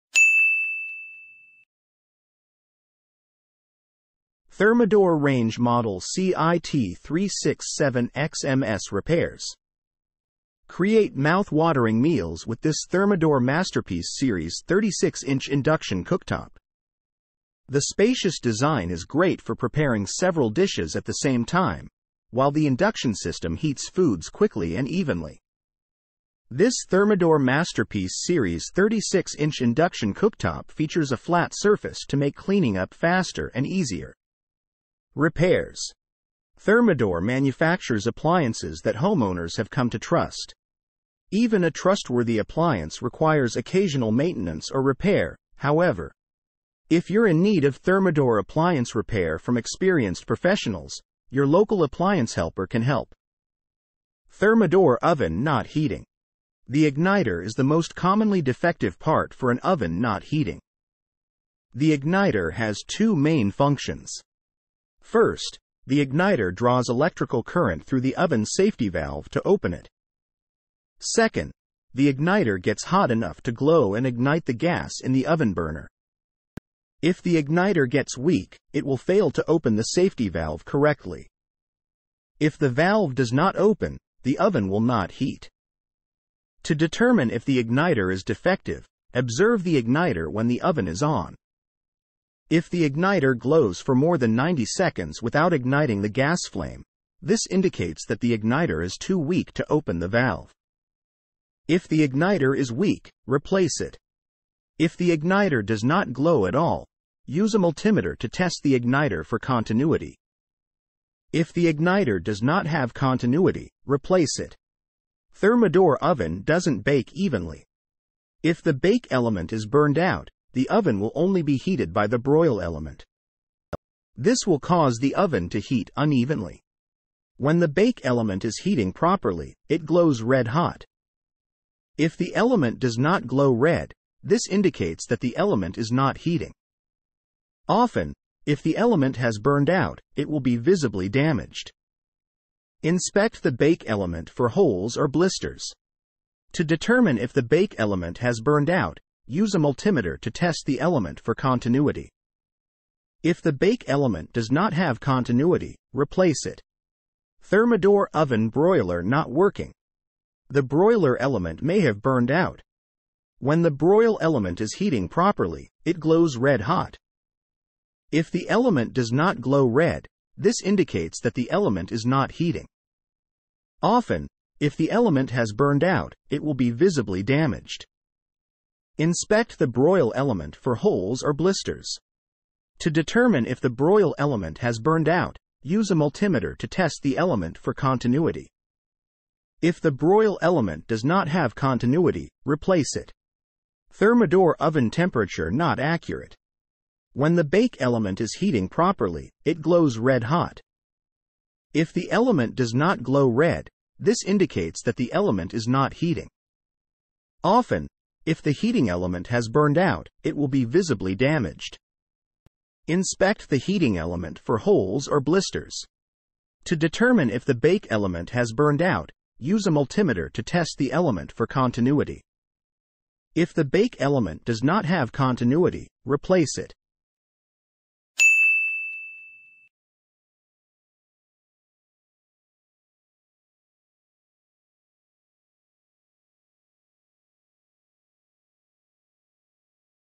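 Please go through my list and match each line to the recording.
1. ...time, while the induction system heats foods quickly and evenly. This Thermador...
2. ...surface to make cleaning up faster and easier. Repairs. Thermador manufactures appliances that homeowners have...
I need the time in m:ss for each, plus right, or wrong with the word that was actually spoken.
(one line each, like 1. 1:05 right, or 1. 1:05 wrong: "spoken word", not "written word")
1. 0:21 right
2. 0:31 right.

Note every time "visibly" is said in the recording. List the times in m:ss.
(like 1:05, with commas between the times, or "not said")
2:20, 2:56, 3:30.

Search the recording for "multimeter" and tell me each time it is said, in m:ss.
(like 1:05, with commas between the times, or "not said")
1:47, 2:29, 3:05, 3:39.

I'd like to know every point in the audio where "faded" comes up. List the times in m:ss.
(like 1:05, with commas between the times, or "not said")
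not said.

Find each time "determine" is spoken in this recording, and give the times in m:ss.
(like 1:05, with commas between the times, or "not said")
1:26, 2:26, 3:02, 3:36.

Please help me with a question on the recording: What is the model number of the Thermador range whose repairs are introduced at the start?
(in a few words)
CIT367XMS.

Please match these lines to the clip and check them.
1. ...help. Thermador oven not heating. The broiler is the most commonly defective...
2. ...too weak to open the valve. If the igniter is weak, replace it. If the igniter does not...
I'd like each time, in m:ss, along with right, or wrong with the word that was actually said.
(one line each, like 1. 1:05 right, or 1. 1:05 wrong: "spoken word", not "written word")
1. 0:52 wrong: "igniter", not "broiler"
2. 1:38 right.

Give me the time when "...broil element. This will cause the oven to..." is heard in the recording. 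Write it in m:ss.
2:02.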